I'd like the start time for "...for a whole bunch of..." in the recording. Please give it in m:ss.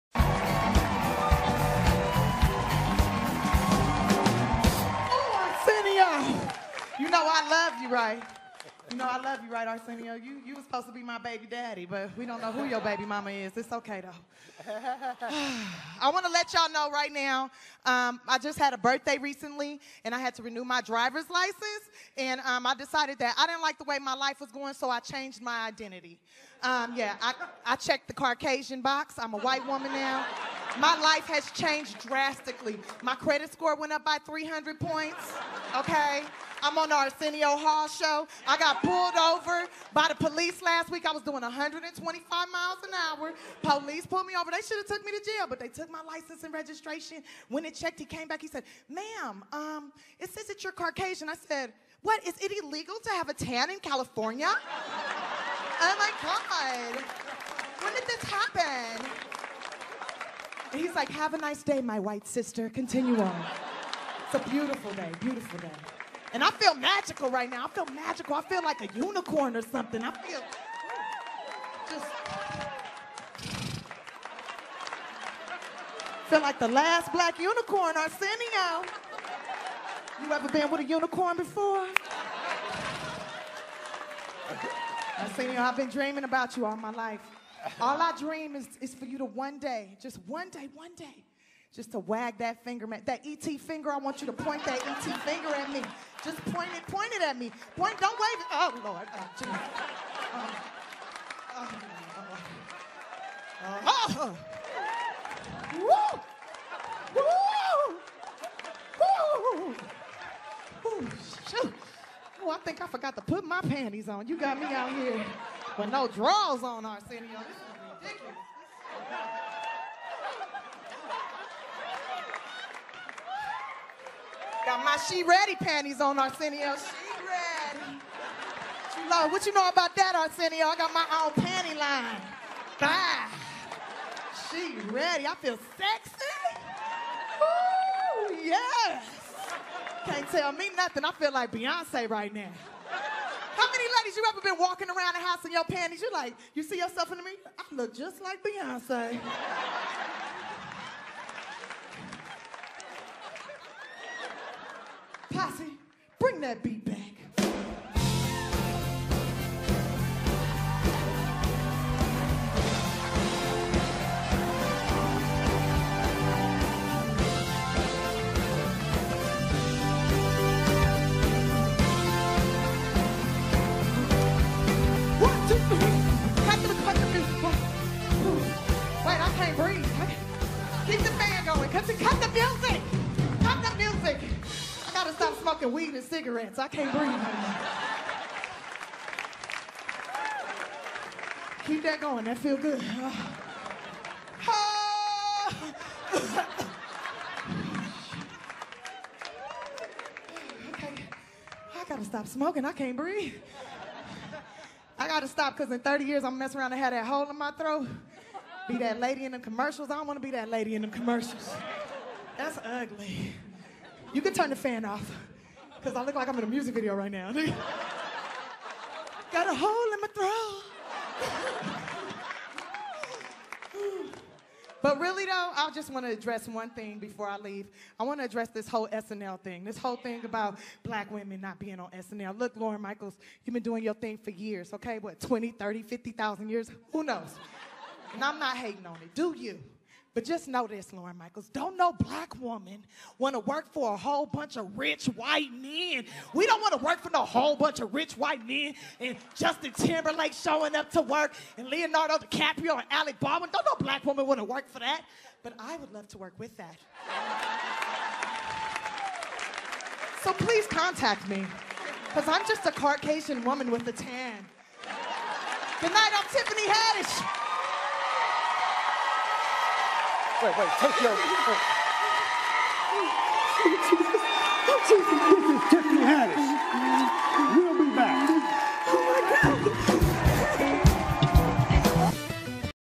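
4:03.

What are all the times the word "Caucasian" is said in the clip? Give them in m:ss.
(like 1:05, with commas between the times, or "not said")
0:28, 0:50, 4:22.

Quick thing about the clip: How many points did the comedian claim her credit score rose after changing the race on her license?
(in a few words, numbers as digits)
300.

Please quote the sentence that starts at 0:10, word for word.
You, you were supposed to be my baby daddy, but we don't know who your baby mama is.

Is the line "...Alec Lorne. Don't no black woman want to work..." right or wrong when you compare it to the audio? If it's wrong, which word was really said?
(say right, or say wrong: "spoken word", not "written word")
wrong: "Baldwin", not "Lorne".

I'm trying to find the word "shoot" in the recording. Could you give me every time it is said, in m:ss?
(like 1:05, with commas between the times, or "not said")
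1:51.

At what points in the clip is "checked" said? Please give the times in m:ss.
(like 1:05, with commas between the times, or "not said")
0:27, 0:47.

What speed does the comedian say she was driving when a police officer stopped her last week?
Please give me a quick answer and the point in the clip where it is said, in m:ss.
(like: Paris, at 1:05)
125 miles an hour, at 0:41.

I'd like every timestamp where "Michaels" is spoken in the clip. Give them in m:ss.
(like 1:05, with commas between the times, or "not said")
3:52, 4:01.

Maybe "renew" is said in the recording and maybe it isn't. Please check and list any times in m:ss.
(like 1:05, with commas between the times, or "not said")
0:20.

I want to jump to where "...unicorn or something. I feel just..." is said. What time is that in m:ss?
1:08.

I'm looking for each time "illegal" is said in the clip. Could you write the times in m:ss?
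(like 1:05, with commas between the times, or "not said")
0:52.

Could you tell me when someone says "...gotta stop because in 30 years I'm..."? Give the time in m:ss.
3:25.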